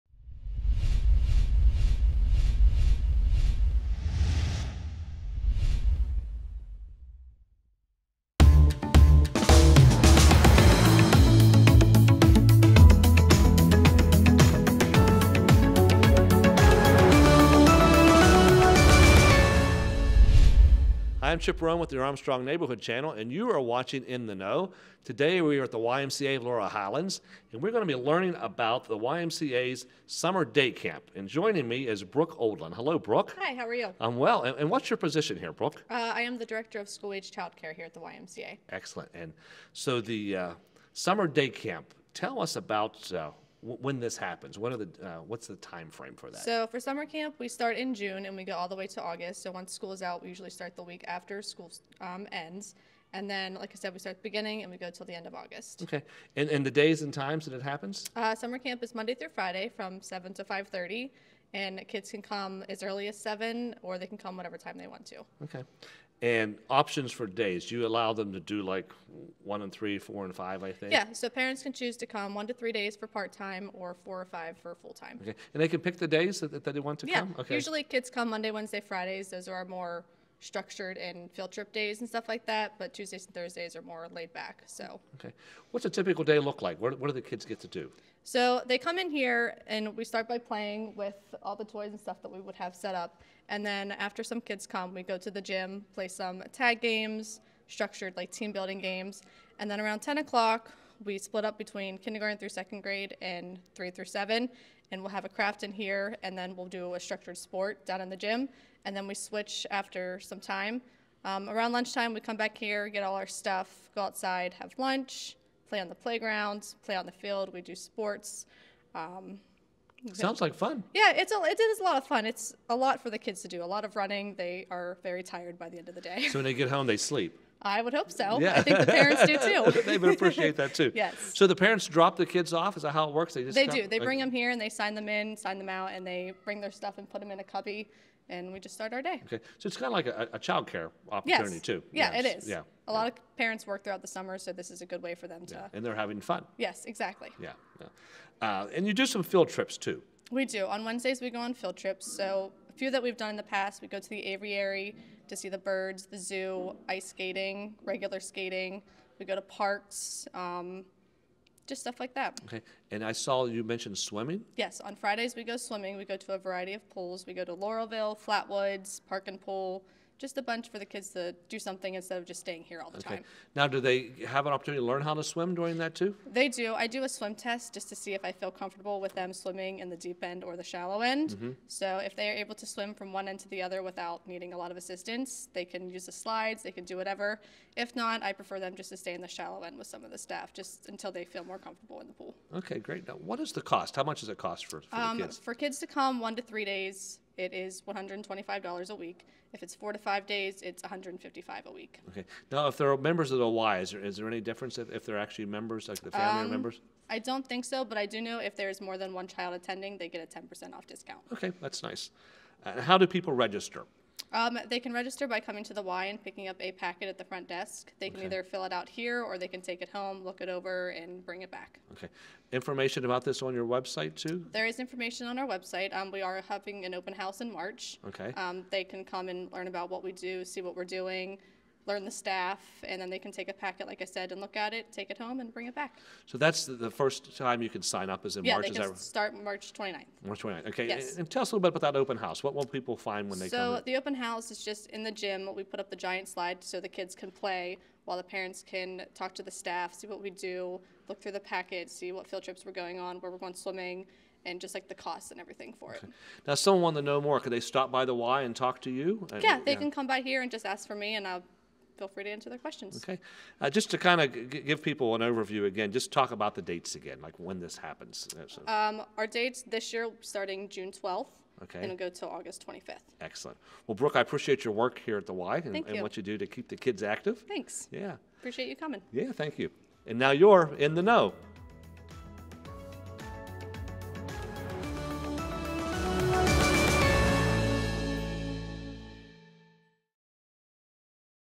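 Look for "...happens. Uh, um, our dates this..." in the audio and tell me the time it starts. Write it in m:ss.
4:27.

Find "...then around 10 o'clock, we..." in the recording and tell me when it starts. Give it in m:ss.
1:39.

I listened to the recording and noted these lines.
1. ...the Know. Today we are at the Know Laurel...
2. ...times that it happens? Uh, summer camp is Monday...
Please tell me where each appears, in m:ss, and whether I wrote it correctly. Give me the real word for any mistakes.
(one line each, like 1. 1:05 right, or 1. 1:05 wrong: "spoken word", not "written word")
1. 0:24 wrong: "YMCA", not "Know"
2. 0:57 right.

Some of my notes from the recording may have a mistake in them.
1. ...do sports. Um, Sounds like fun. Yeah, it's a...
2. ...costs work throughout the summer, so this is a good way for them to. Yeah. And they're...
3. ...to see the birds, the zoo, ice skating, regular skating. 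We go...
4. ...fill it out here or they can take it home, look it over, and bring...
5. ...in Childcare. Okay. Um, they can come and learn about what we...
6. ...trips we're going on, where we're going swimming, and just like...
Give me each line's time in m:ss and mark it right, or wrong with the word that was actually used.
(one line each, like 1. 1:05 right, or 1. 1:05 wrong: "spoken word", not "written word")
1. 1:57 right
2. 2:23 wrong: "parents", not "costs"
3. 2:35 right
4. 3:38 right
5. 3:47 wrong: "March", not "Childcare"
6. 4:12 right.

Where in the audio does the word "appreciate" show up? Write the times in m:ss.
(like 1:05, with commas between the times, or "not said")
2:10, 4:34, 4:38.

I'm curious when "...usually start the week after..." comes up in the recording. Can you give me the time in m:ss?
0:50.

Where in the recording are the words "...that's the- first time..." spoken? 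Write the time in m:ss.
3:56.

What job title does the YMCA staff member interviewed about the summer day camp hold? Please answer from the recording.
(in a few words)
Director of School Age Childcare.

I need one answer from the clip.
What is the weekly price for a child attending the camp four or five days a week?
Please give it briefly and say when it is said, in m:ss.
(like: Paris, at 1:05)
$155, at 3:20.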